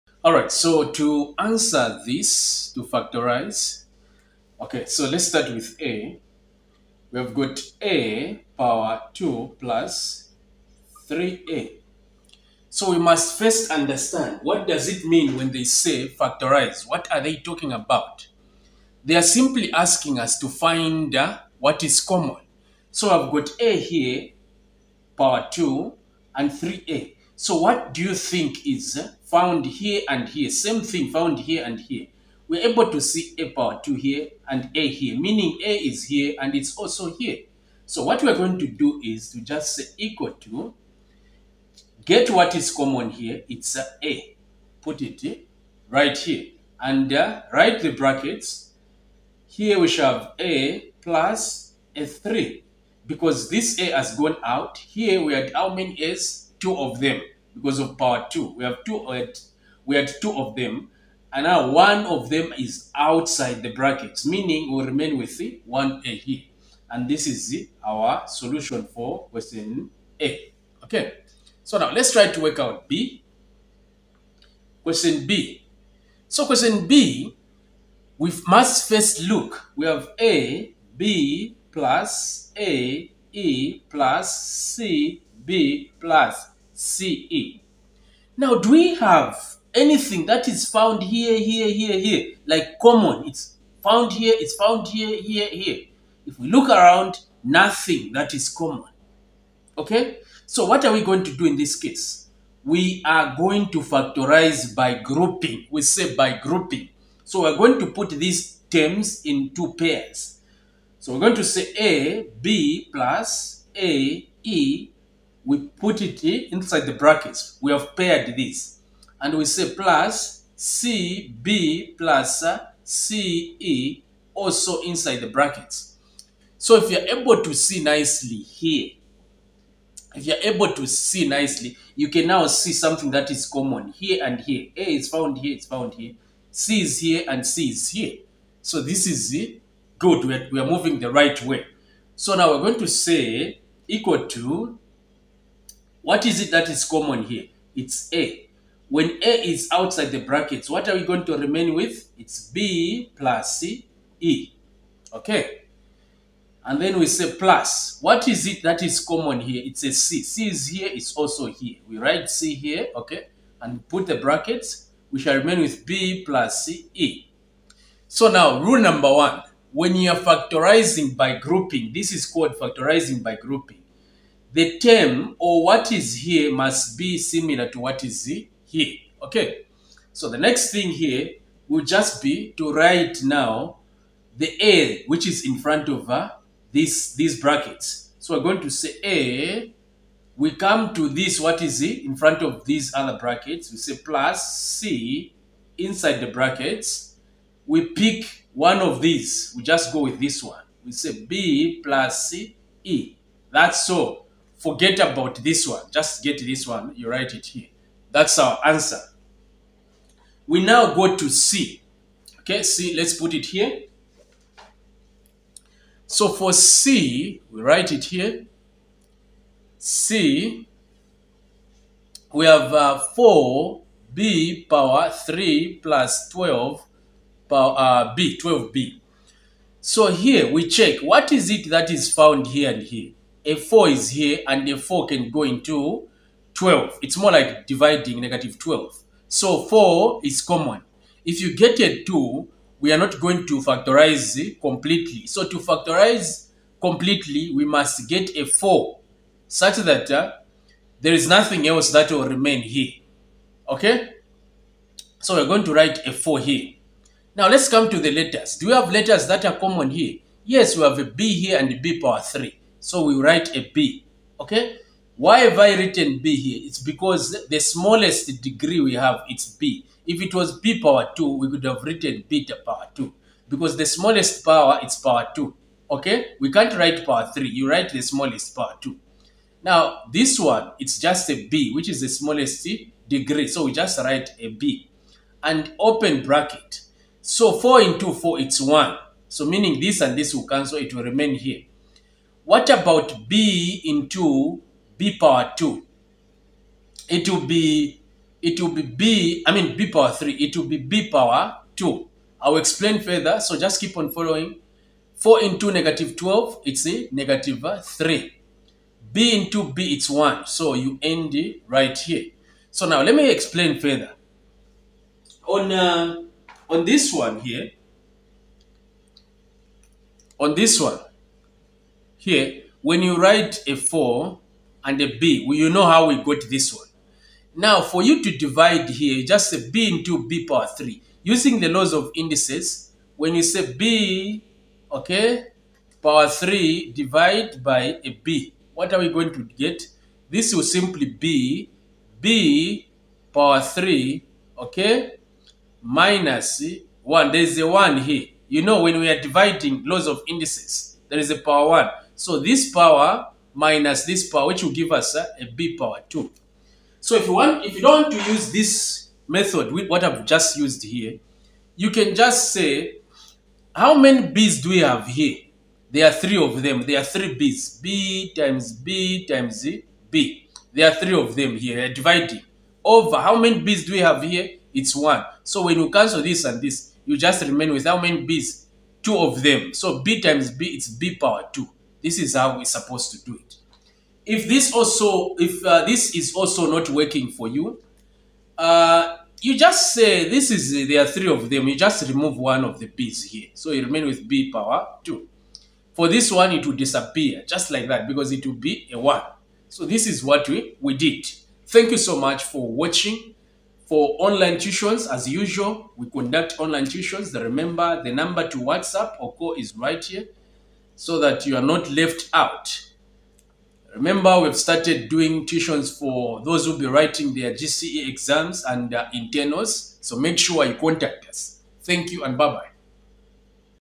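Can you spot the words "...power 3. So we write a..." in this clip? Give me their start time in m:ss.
4:21.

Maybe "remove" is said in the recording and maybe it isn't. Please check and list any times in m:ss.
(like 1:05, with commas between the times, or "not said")
6:32.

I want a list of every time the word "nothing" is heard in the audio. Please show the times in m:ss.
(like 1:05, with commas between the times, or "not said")
1:37, 4:11.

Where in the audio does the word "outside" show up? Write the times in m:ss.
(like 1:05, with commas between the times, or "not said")
1:02, 2:29.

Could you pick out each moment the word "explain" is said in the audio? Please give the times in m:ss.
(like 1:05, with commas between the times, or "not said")
5:02, 5:13.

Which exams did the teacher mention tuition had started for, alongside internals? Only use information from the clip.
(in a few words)
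GCE.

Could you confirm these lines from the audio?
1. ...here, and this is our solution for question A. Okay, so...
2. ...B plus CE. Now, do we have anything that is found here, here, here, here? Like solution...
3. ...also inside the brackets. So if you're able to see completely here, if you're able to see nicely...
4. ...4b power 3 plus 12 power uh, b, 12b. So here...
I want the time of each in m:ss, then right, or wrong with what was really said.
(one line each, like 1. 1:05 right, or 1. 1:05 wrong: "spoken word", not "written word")
1. 1:06 right
2. 1:25 wrong: "common", not "solution"
3. 2:04 wrong: "nicely", not "completely"
4. 3:43 right.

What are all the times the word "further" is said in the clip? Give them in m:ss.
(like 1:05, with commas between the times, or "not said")
5:03, 5:13.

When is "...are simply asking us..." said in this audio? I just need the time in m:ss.
0:19.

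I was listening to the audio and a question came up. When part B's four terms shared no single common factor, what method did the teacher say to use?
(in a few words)
factorize by grouping.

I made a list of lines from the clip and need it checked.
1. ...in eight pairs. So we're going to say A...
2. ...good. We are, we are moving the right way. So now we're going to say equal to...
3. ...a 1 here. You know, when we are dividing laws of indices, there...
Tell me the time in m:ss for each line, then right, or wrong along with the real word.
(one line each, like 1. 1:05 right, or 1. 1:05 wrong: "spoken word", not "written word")
1. 1:49 wrong: "two", not "eight"
2. 2:19 right
3. 5:47 right.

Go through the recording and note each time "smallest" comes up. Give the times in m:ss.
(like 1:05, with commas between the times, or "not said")
4:27, 4:33, 4:38, 4:42.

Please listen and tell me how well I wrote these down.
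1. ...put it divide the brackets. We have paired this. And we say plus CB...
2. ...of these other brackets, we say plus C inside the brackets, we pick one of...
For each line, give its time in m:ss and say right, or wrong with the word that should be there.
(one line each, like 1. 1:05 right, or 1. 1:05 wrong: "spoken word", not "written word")
1. 1:55 wrong: "inside", not "divide"
2. 3:12 right.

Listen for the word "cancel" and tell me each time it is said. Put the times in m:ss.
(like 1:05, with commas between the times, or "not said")
4:50, 6:15.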